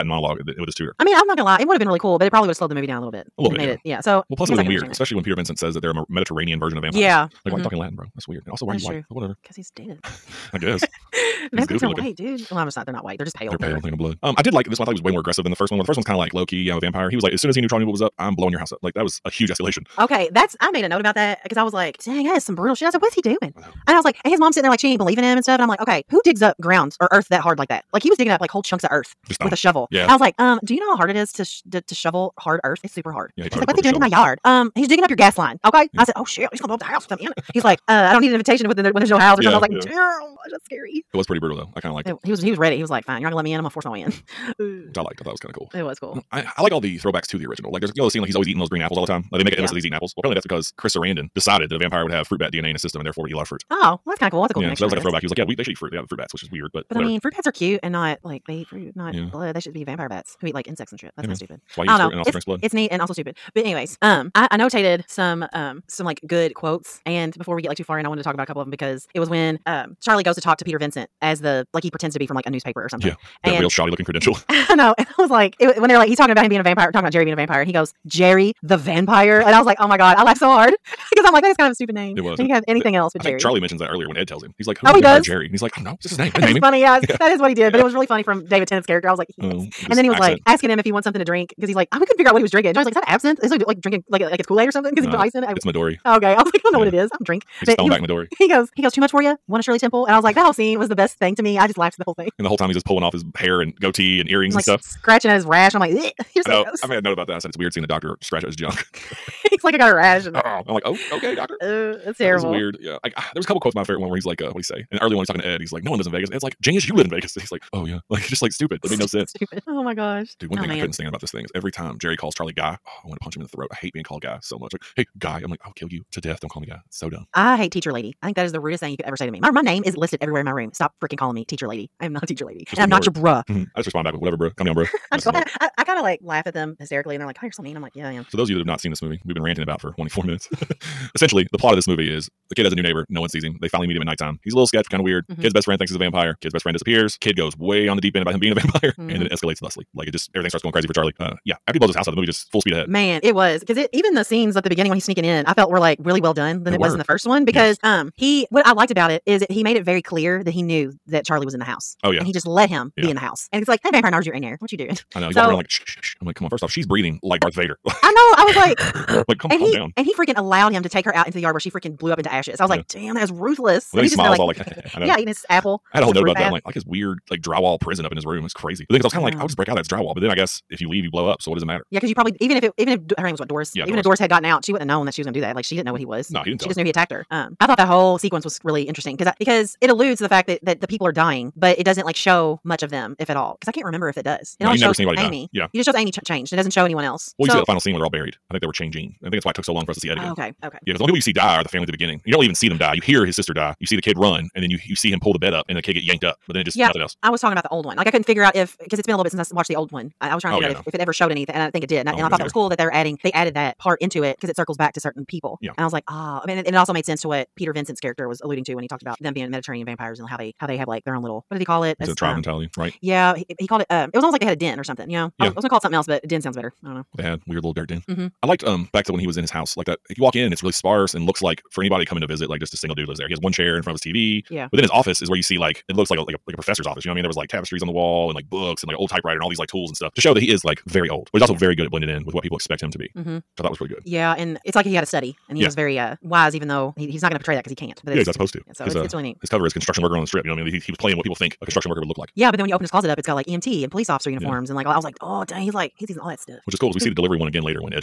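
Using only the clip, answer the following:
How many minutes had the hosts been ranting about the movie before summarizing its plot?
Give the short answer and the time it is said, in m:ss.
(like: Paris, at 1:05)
24, at 2:19.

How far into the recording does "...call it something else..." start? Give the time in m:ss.
3:45.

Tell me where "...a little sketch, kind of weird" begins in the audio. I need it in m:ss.
2:24.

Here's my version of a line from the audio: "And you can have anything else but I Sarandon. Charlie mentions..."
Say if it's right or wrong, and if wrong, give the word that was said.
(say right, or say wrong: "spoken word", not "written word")
wrong: "Jerry", not "Sarandon".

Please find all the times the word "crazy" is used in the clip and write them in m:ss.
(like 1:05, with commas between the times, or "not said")
2:30, 2:58.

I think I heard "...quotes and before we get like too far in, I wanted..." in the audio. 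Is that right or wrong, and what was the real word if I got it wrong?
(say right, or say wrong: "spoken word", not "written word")
right.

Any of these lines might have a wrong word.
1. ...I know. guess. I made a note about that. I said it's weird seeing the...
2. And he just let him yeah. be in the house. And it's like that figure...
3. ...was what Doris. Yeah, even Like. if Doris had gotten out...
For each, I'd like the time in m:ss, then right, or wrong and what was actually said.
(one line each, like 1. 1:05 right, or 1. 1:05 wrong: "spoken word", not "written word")
1. 1:46 wrong: "gross", not "guess"
2. 2:42 wrong: "vampire", not "figure"
3. 3:03 wrong: "Doris", not "Like".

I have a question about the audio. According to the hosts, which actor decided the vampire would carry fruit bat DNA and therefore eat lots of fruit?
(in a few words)
Chris Sarandon.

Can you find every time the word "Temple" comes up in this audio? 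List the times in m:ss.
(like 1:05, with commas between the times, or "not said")
1:39.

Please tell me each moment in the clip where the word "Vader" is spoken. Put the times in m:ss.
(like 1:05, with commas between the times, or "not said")
2:47.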